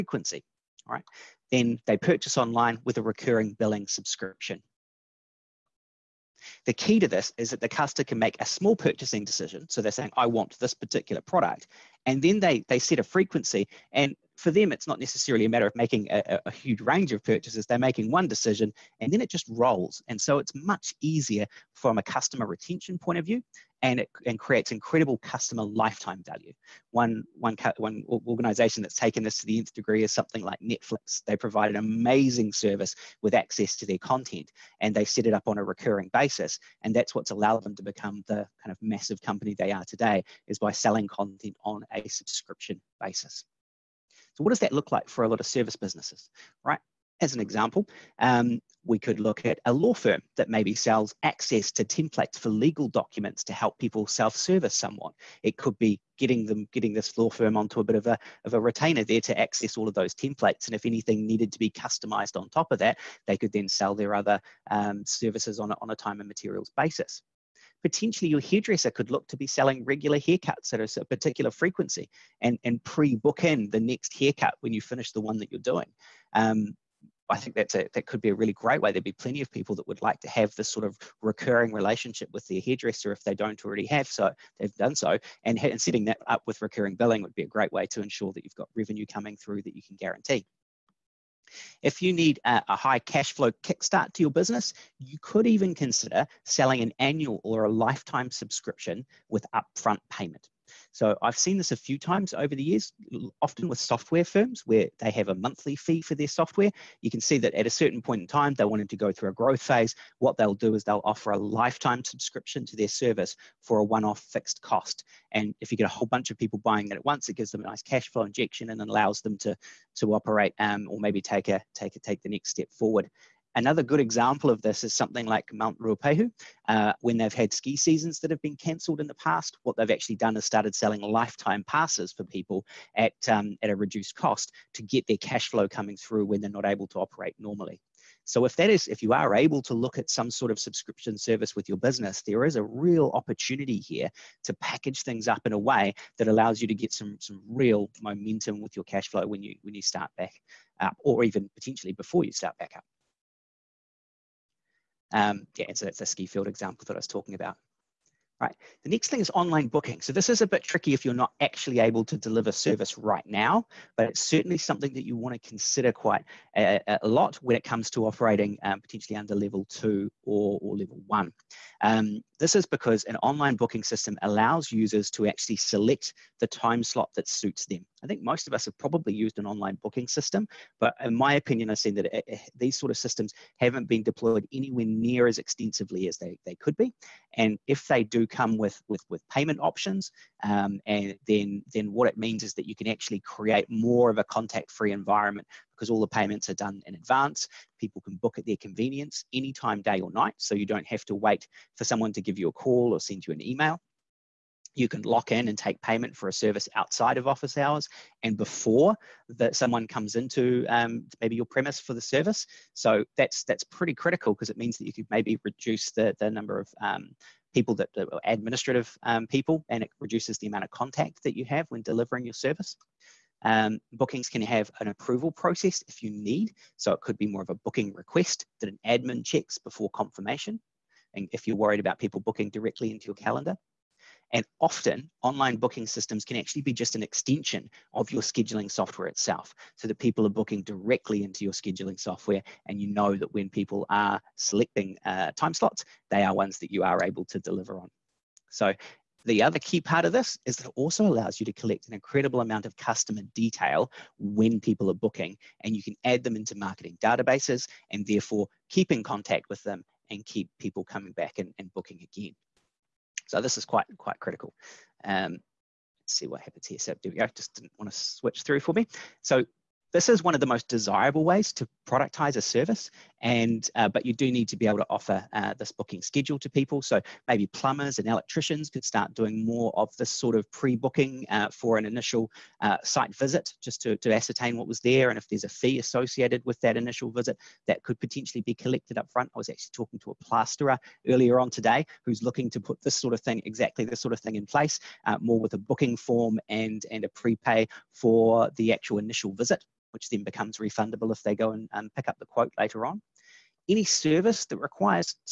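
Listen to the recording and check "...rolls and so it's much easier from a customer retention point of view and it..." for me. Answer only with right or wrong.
right.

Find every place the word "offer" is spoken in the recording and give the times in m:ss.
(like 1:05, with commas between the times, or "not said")
1:51, 4:34.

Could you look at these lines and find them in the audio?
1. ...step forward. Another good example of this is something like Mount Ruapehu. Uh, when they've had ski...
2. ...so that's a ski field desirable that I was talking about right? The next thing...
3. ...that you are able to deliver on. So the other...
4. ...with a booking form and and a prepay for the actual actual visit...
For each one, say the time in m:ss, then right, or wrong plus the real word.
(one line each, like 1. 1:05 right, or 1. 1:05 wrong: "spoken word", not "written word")
1. 2:02 right
2. 2:35 wrong: "example", not "desirable"
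3. 4:06 right
4. 4:55 wrong: "initial", not "actual".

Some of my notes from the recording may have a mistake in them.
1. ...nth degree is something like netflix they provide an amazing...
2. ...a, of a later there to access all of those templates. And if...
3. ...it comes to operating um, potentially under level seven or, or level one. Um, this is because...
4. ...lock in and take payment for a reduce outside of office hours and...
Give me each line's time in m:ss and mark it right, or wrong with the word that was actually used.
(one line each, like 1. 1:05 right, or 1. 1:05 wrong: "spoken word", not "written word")
1. 0:29 right
2. 0:58 wrong: "retainer", not "later"
3. 2:47 wrong: "two", not "seven"
4. 3:25 wrong: "service", not "reduce".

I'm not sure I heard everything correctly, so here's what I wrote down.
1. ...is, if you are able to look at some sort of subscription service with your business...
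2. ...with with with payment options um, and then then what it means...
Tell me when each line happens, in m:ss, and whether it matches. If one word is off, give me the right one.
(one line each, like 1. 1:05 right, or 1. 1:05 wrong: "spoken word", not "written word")
1. 2:18 right
2. 3:08 right.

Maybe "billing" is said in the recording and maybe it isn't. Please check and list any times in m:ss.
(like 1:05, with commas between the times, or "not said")
0:03, 1:26.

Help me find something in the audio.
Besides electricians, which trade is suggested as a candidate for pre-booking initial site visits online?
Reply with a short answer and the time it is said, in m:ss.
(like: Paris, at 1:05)
Plumbers, at 4:37.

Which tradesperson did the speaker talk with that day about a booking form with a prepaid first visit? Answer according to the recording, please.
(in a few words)
Plasterer.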